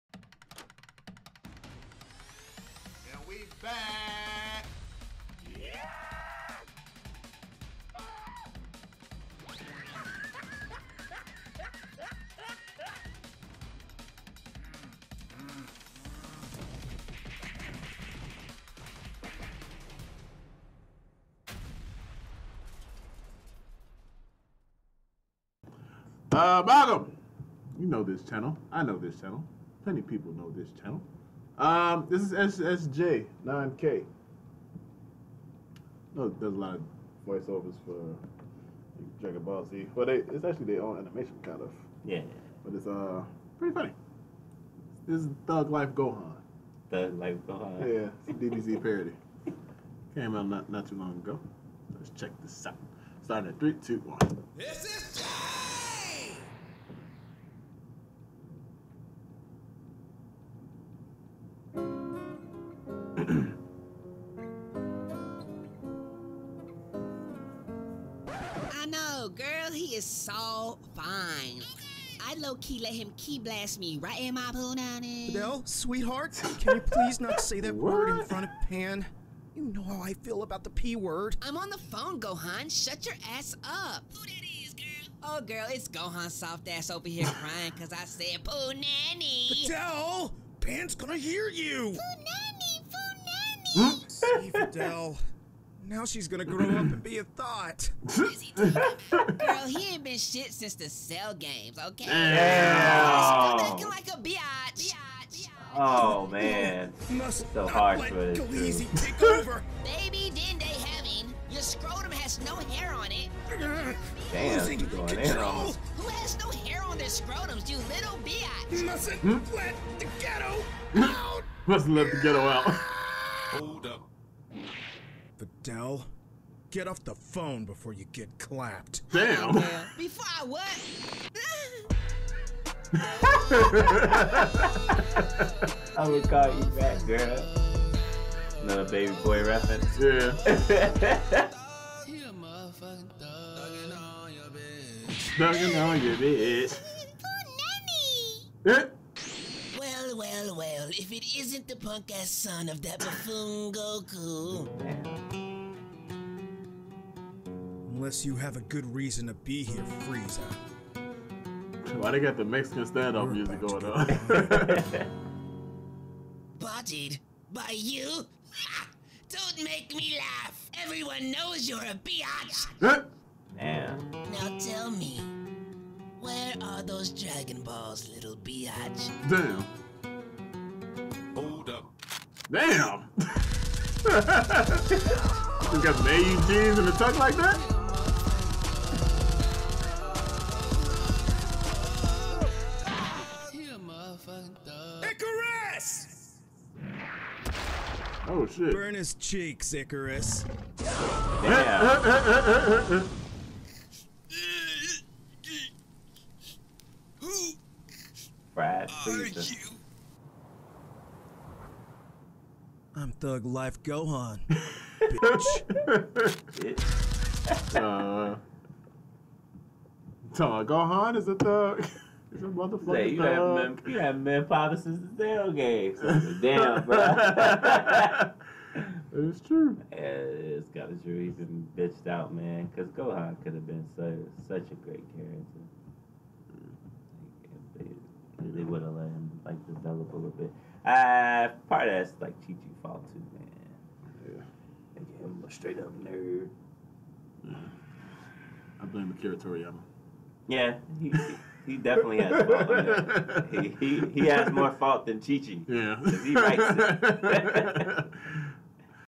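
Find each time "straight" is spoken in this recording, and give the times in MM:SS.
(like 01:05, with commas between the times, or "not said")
04:05.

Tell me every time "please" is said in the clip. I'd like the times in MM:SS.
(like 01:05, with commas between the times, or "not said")
01:16, 03:28.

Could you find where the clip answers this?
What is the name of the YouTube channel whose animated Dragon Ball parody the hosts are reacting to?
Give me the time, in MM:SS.
00:32.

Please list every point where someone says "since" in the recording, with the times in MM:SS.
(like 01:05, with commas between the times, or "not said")
01:40, 03:44.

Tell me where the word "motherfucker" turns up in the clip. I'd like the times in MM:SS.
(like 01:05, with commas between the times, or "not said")
03:42.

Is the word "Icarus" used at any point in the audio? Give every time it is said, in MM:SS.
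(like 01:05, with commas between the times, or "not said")
03:15, 03:19.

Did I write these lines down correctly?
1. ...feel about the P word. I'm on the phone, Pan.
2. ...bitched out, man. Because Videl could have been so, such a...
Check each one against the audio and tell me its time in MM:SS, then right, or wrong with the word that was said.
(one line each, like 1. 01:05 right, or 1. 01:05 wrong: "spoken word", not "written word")
1. 01:20 wrong: "Gohan", not "Pan"
2. 03:51 wrong: "Gohan", not "Videl".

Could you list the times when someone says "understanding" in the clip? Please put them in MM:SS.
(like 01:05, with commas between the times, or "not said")
not said.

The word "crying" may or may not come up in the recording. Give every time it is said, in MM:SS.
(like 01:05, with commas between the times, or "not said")
01:27.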